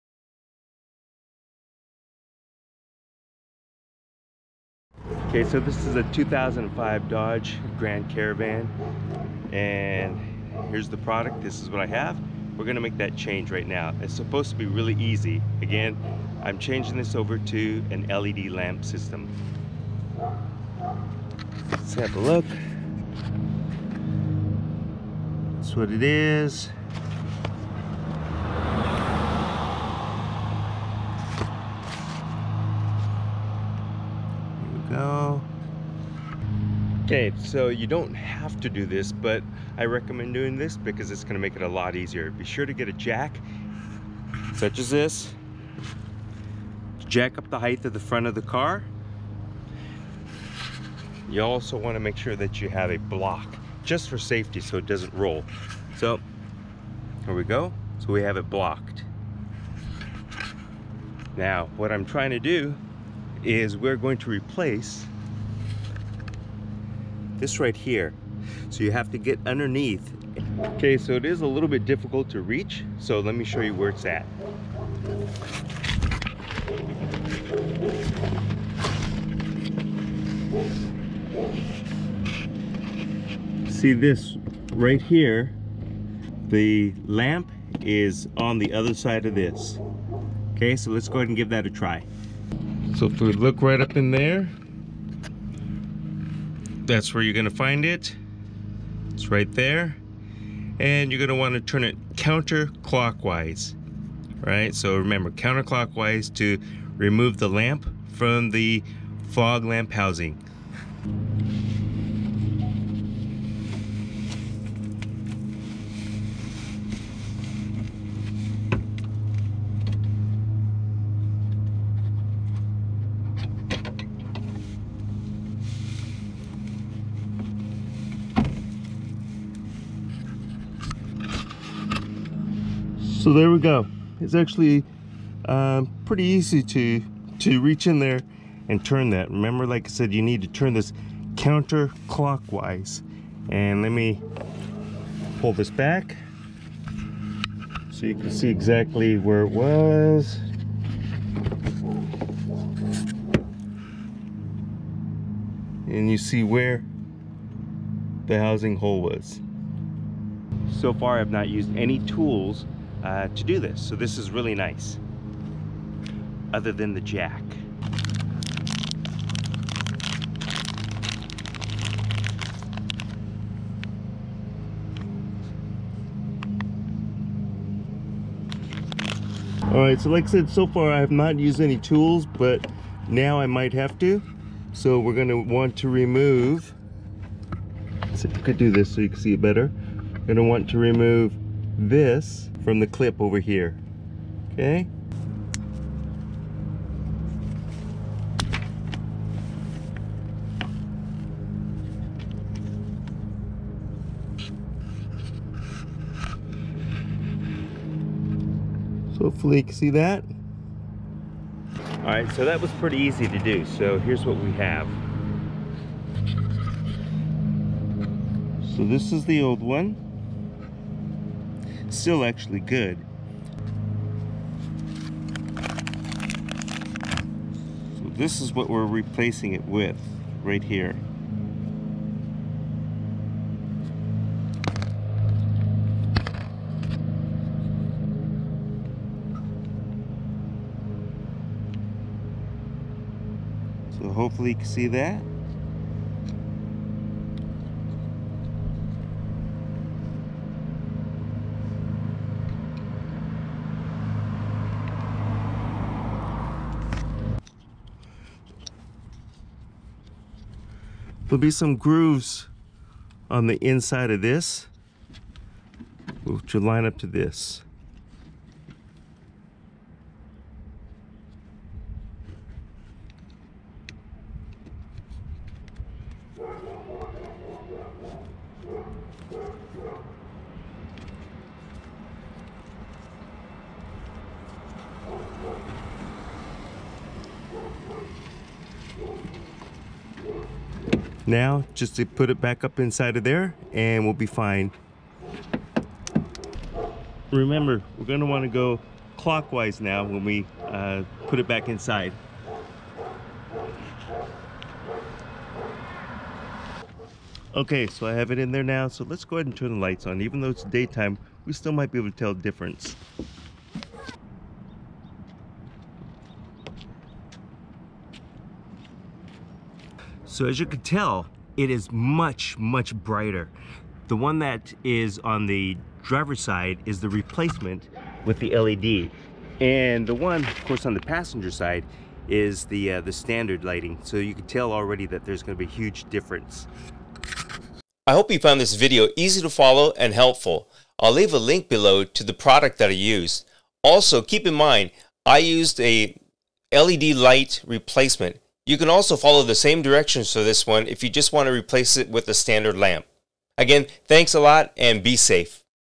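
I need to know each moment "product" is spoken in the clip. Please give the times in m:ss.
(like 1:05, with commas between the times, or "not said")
0:10, 5:42.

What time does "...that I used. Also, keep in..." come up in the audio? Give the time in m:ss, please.
5:42.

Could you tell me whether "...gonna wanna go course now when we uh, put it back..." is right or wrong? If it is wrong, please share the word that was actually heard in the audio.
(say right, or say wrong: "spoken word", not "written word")
wrong: "clockwise", not "course".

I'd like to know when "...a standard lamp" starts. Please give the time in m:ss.
5:52.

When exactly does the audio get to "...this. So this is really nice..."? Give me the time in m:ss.
2:43.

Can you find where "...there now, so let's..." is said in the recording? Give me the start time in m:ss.
5:08.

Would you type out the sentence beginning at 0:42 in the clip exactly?
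Be sure to get a jack, such as this.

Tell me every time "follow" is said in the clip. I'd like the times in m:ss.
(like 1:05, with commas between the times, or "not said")
5:39, 5:49.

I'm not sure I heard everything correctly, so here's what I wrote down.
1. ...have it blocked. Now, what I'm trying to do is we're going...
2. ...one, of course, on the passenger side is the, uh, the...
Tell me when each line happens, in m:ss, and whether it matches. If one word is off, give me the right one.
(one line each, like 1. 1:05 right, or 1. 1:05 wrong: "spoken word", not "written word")
1. 0:58 right
2. 5:30 right.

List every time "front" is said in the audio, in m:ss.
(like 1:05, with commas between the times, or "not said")
0:48.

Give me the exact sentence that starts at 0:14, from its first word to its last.
It's supposed to be really easy.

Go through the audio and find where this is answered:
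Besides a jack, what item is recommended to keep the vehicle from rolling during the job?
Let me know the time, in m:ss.
0:52.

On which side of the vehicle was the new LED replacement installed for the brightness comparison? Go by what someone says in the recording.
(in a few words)
Driver's side.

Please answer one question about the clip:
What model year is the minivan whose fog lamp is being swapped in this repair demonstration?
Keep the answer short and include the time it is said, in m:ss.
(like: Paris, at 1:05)
2005, at 0:06.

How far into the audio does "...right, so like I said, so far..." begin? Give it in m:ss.
2:59.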